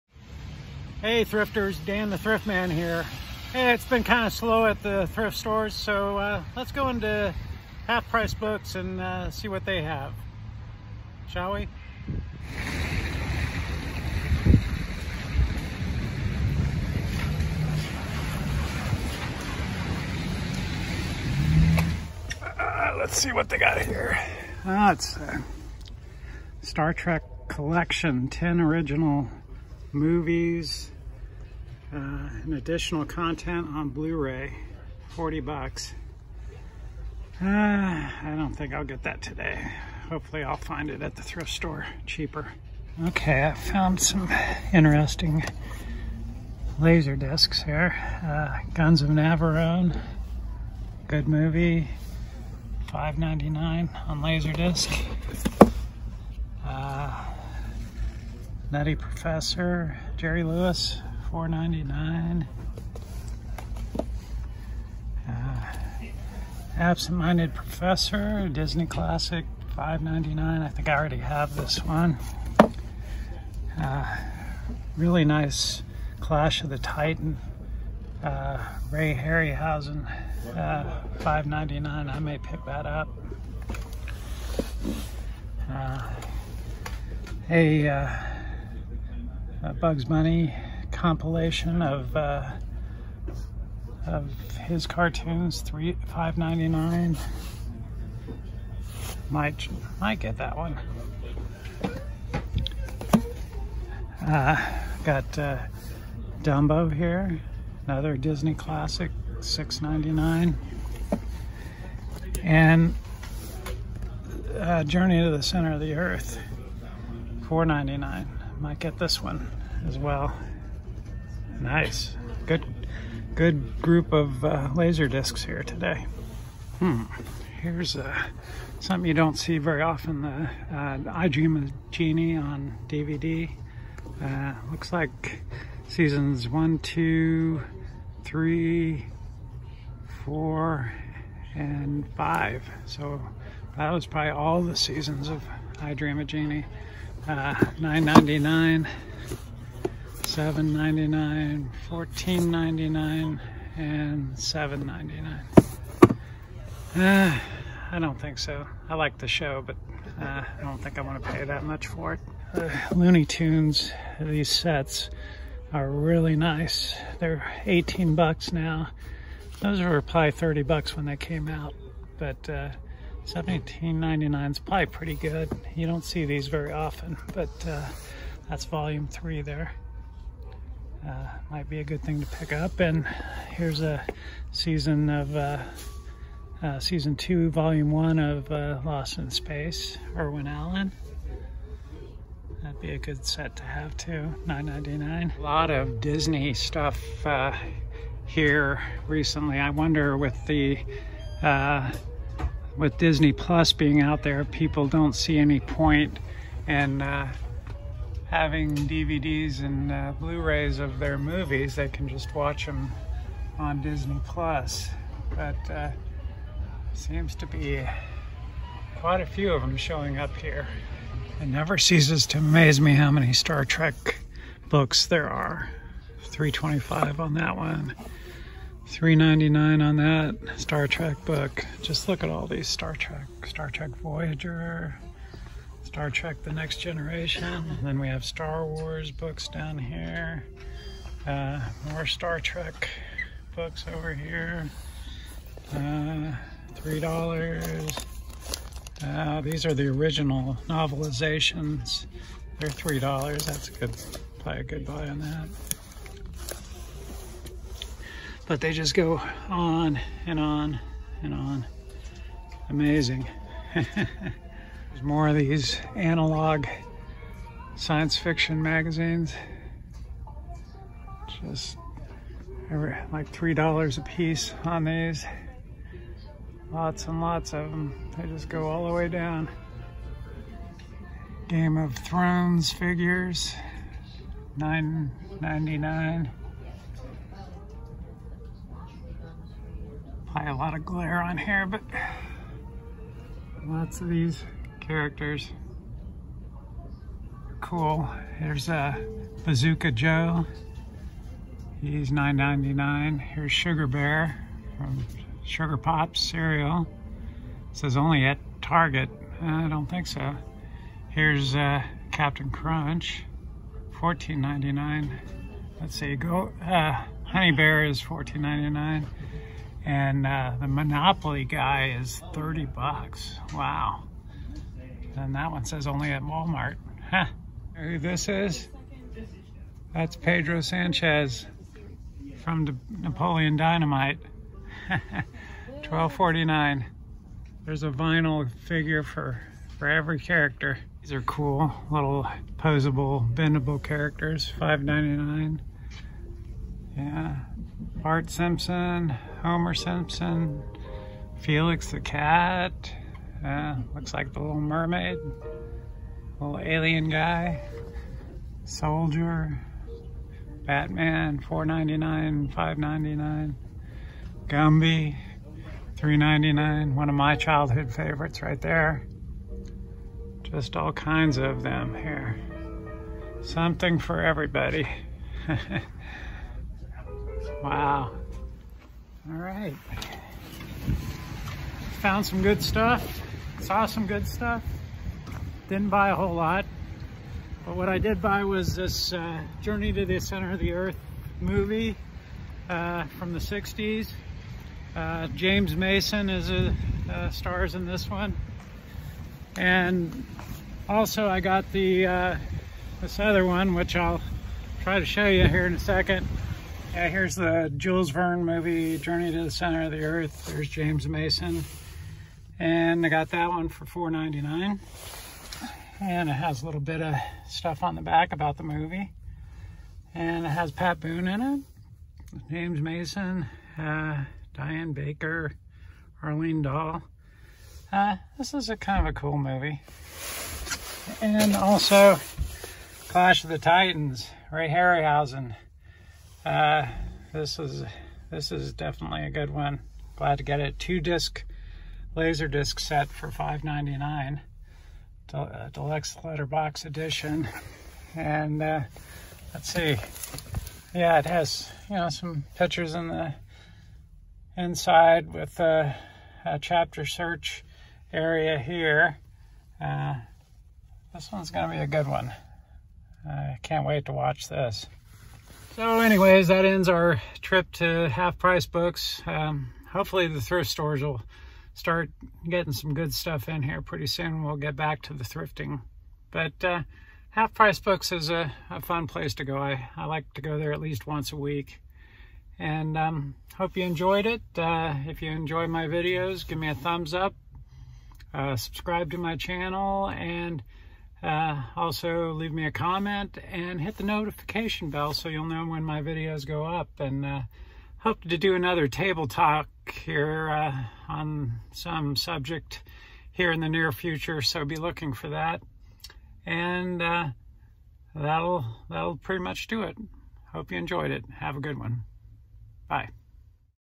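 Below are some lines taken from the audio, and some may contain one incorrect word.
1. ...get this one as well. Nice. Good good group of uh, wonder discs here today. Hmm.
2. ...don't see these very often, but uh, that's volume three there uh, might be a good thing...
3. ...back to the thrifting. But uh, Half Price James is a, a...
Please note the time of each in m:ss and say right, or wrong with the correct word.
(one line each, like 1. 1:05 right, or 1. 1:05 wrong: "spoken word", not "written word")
1. 1:58 wrong: "laser", not "wonder"
2. 2:55 right
3. 7:54 wrong: "Books", not "James".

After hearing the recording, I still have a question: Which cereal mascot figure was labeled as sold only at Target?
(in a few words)
Sugar Bear.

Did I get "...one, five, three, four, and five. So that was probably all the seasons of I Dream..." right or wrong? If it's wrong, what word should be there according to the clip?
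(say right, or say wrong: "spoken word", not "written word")
wrong: "two", not "five".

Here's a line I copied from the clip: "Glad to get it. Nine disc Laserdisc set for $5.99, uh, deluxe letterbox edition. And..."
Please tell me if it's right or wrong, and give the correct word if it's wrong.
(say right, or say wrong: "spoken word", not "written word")
wrong: "Two", not "Nine".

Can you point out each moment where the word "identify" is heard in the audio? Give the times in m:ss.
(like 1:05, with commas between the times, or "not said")
not said.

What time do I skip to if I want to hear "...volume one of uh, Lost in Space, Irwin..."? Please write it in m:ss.
3:07.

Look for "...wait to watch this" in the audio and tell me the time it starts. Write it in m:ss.
7:43.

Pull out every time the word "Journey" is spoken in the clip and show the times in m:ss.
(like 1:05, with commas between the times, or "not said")
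1:54, 6:29, 6:48.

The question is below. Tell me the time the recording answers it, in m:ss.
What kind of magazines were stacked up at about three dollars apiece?
4:25.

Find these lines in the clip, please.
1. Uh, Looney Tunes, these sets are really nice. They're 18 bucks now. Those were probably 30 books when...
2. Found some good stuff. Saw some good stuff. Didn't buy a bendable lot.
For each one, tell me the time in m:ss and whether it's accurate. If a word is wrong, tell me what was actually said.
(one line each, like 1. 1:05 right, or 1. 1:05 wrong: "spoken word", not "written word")
1. 2:42 wrong: "bucks", not "books"
2. 6:22 wrong: "whole", not "bendable".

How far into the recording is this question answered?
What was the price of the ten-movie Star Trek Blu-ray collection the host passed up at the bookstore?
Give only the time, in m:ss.
0:35.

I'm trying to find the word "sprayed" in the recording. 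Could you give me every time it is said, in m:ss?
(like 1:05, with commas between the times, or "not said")
not said.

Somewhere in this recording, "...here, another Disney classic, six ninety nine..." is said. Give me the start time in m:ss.
1:46.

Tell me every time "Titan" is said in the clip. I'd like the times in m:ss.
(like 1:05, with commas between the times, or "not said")
1:16, 7:13.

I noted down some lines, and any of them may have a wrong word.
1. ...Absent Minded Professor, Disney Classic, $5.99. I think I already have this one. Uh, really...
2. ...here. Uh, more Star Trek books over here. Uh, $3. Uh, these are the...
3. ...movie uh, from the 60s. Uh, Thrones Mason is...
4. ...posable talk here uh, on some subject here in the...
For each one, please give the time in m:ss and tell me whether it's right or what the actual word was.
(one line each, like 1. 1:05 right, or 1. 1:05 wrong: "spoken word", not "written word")
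1. 1:06 right
2. 3:59 right
3. 6:31 wrong: "James", not "Thrones"
4. 8:18 wrong: "table", not "posable".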